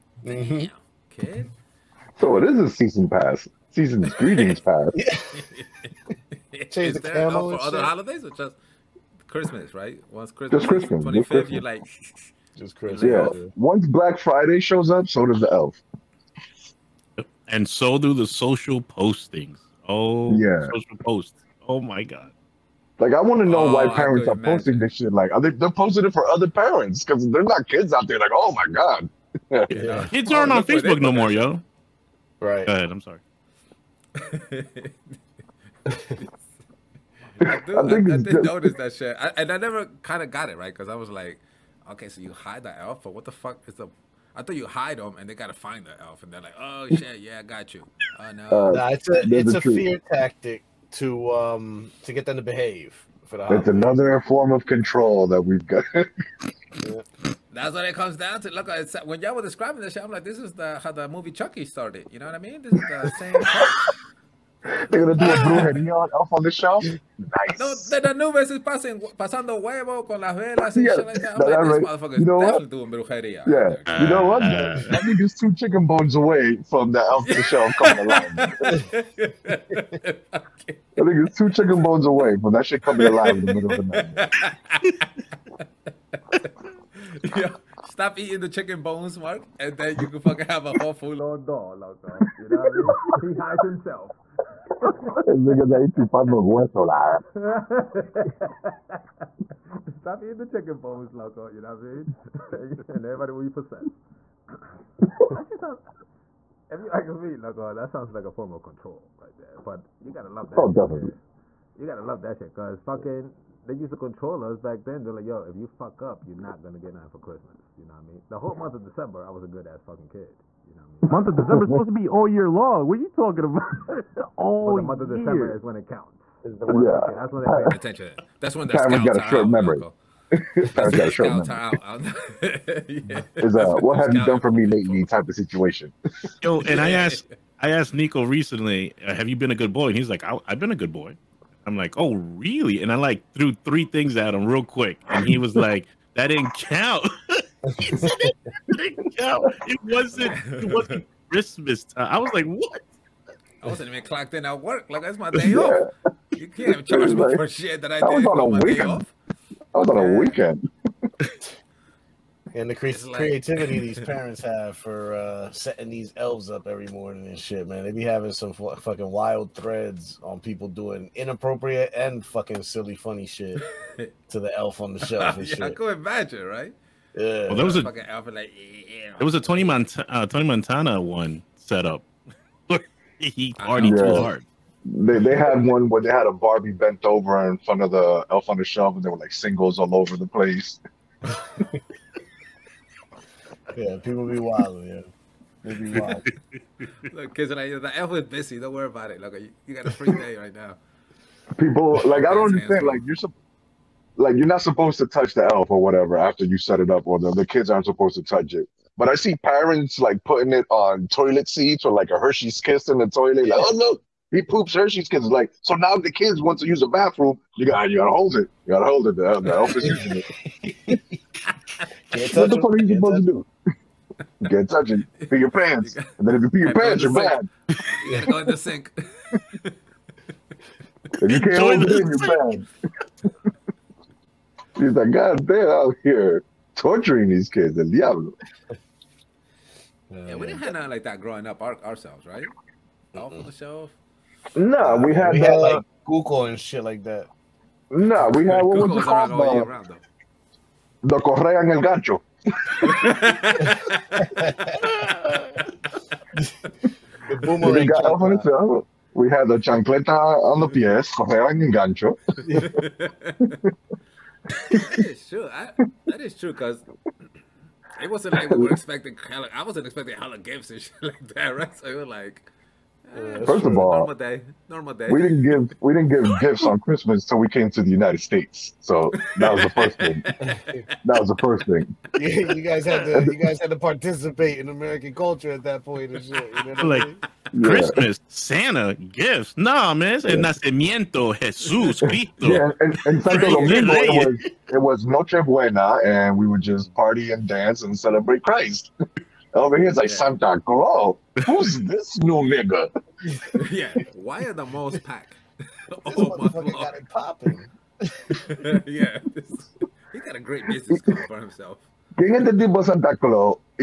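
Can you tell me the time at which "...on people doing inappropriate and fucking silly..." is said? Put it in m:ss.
2:50.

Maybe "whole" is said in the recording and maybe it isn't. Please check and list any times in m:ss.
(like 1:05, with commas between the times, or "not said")
1:30, 1:58.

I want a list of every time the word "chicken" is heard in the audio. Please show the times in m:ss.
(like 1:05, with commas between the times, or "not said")
1:15, 1:21, 1:28, 1:40.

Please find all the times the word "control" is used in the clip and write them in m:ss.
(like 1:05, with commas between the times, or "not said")
0:54, 1:48, 1:53.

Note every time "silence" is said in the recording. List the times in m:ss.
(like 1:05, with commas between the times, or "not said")
not said.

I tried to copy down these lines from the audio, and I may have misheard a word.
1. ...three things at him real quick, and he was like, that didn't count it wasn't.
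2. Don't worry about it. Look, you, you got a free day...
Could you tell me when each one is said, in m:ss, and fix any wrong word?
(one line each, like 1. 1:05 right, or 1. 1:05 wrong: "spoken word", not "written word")
1. 2:23 right
2. 3:18 right.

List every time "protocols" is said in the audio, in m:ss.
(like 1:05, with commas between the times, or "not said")
not said.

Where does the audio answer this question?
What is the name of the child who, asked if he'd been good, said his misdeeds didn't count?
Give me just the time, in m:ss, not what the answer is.
2:17.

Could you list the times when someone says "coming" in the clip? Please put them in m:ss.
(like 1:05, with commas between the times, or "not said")
1:17, 1:22.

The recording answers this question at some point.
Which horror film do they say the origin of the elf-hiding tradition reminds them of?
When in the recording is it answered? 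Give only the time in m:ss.
1:01.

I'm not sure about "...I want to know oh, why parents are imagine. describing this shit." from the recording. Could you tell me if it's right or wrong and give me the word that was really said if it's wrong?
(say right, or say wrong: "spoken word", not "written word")
wrong: "posting", not "describing".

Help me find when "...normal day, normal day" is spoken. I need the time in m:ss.
4:33.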